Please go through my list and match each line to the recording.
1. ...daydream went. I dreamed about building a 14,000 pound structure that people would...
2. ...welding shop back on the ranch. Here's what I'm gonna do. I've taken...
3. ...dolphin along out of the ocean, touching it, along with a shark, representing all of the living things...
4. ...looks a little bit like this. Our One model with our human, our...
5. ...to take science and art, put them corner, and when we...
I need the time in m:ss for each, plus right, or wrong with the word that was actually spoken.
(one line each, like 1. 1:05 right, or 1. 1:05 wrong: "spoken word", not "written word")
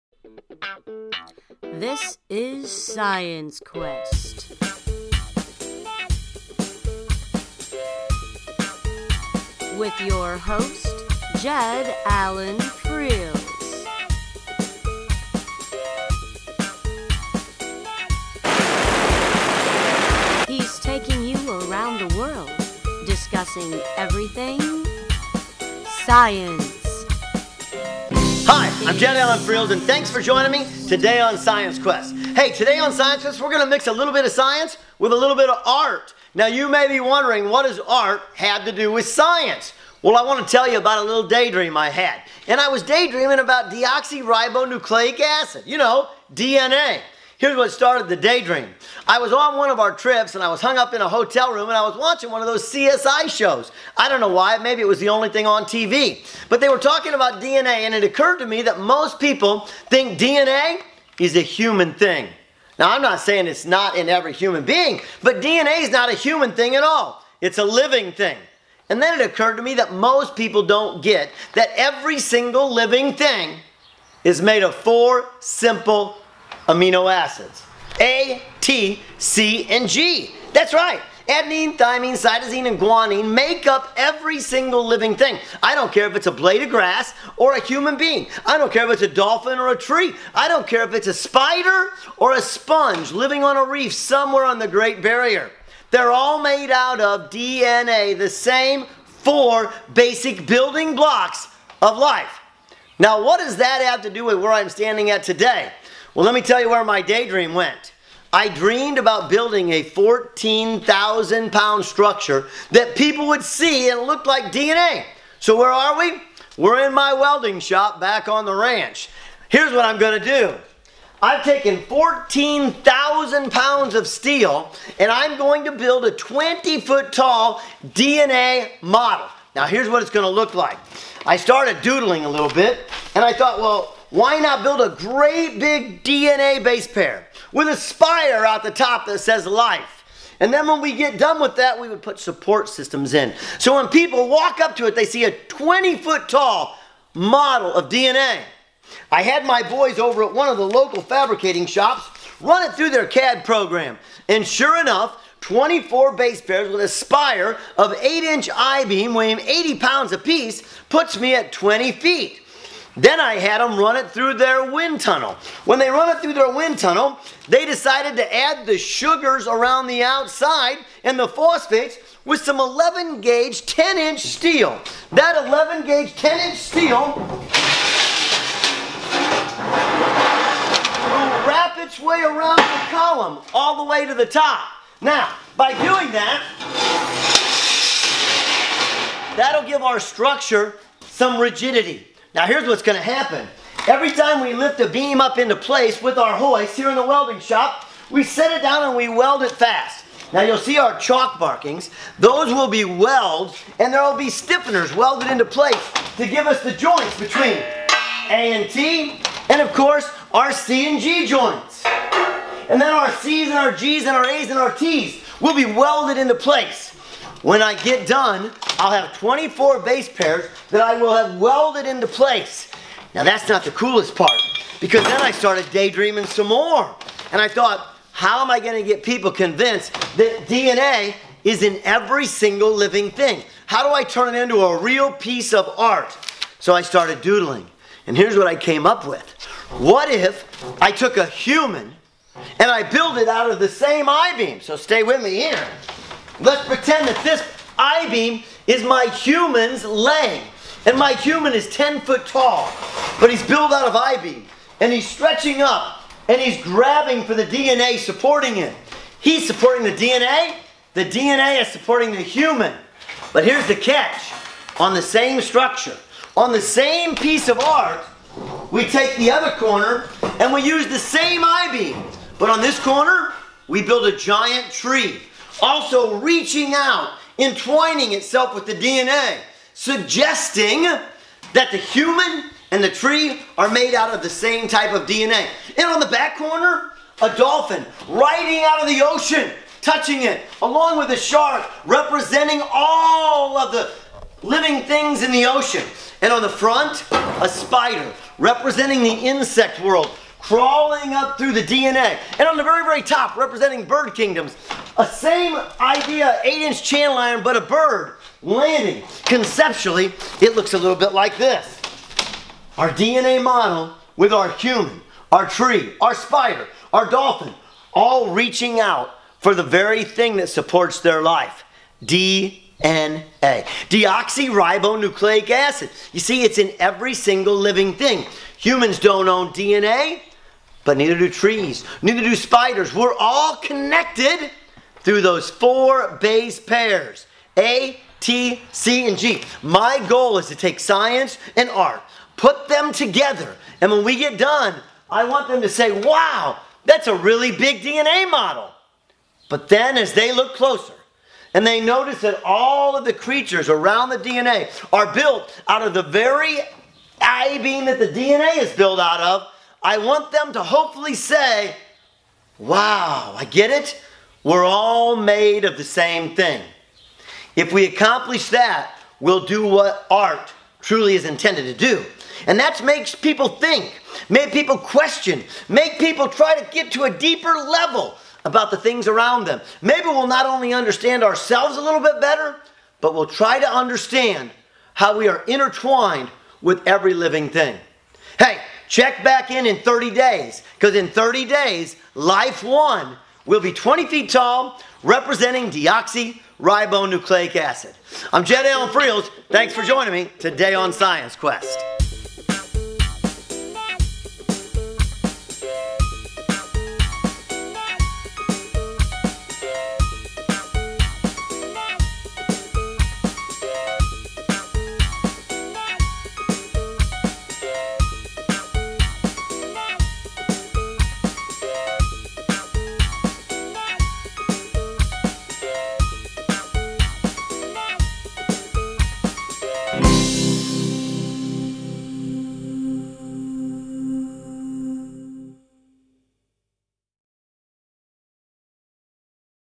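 1. 1:47 right
2. 1:57 right
3. 4:47 wrong: "riding", not "along"
4. 5:10 wrong: "DNA", not "One"
5. 5:40 wrong: "together", not "corner".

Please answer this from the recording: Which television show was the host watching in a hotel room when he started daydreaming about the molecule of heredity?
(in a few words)
CSI.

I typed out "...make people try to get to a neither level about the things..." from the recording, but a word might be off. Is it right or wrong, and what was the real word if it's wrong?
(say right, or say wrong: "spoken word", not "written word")
wrong: "deeper", not "neither".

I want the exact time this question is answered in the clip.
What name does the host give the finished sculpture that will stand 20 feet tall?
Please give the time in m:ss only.
6:32.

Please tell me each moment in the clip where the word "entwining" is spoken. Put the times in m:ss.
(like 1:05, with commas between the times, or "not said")
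4:37.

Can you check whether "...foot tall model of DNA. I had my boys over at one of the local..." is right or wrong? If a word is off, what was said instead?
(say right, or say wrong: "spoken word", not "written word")
right.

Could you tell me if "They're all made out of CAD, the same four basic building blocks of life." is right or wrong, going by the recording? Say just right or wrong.
wrong.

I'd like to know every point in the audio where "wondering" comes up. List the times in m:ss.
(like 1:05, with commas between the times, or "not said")
0:36.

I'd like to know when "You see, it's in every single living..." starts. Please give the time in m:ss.
5:26.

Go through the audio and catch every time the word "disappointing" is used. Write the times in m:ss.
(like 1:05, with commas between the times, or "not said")
not said.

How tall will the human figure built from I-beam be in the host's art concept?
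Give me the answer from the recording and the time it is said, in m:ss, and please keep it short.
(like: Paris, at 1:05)
10 feet, at 4:11.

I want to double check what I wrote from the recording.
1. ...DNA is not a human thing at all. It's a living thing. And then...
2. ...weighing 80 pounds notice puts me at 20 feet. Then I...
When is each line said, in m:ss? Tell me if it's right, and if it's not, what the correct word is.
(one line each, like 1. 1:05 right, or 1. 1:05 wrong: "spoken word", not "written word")
1. 1:05 right
2. 2:39 wrong: "apiece", not "notice".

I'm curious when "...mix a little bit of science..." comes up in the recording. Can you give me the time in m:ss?
0:33.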